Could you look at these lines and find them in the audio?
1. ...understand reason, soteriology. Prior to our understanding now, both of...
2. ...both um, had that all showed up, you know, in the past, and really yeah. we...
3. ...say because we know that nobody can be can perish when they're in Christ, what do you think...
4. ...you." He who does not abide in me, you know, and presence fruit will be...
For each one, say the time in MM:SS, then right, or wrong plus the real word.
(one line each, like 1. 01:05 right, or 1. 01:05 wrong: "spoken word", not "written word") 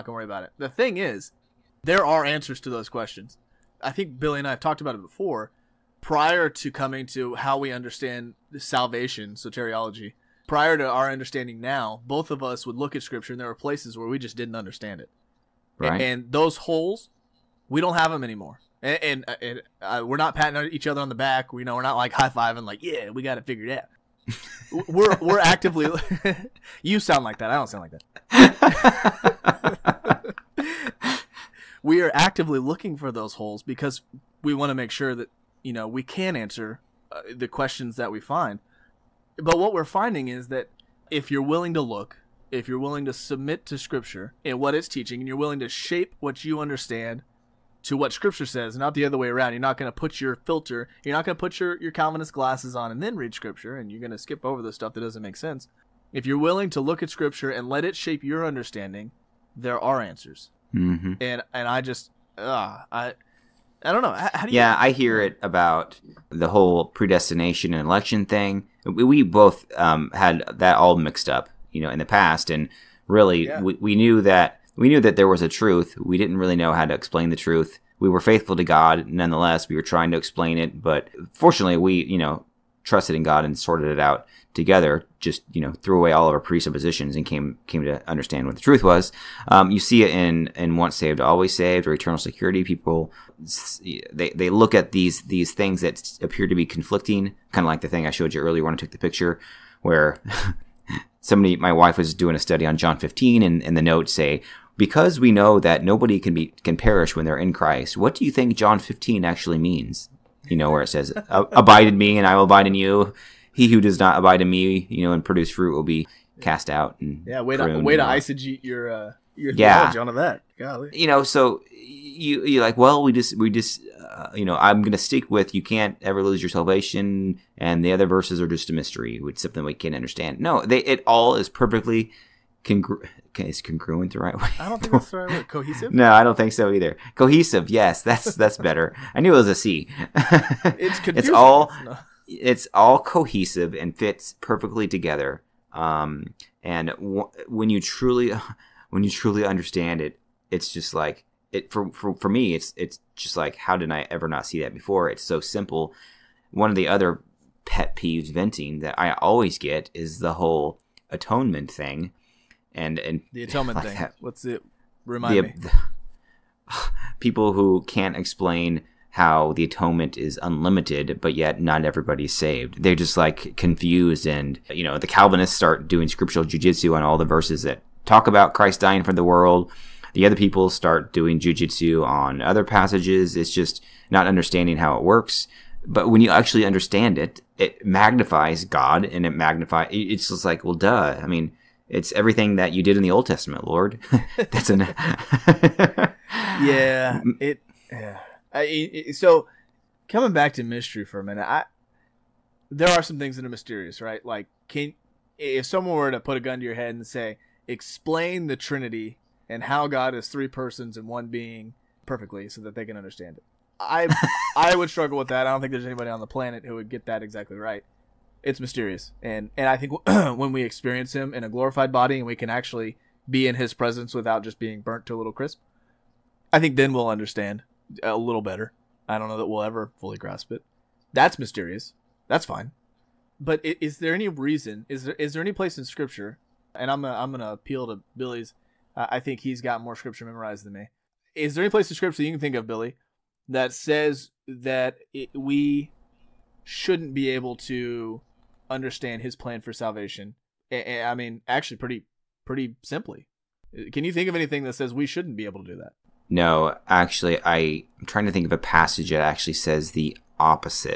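1. 00:07 wrong: "salvation", not "reason"
2. 01:09 wrong: "mixed", not "showed"
3. 01:44 right
4. 01:52 wrong: "produce", not "presence".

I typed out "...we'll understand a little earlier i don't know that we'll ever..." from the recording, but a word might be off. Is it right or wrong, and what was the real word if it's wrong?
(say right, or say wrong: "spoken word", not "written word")
wrong: "better", not "earlier".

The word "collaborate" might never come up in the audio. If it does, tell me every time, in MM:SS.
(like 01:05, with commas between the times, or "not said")
not said.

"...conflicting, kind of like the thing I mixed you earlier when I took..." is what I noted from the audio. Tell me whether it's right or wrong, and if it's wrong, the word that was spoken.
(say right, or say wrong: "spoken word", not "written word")
wrong: "showed", not "mixed".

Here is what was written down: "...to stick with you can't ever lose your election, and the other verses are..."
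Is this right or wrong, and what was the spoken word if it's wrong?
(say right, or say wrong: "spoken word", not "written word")
wrong: "salvation", not "election".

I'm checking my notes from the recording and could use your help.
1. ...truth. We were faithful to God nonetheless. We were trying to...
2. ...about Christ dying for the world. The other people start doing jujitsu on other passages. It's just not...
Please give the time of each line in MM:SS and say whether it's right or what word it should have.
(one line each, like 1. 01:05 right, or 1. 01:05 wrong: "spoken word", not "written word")
1. 01:17 right
2. 02:58 right.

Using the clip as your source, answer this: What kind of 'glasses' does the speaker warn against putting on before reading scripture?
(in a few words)
Calvinist glasses.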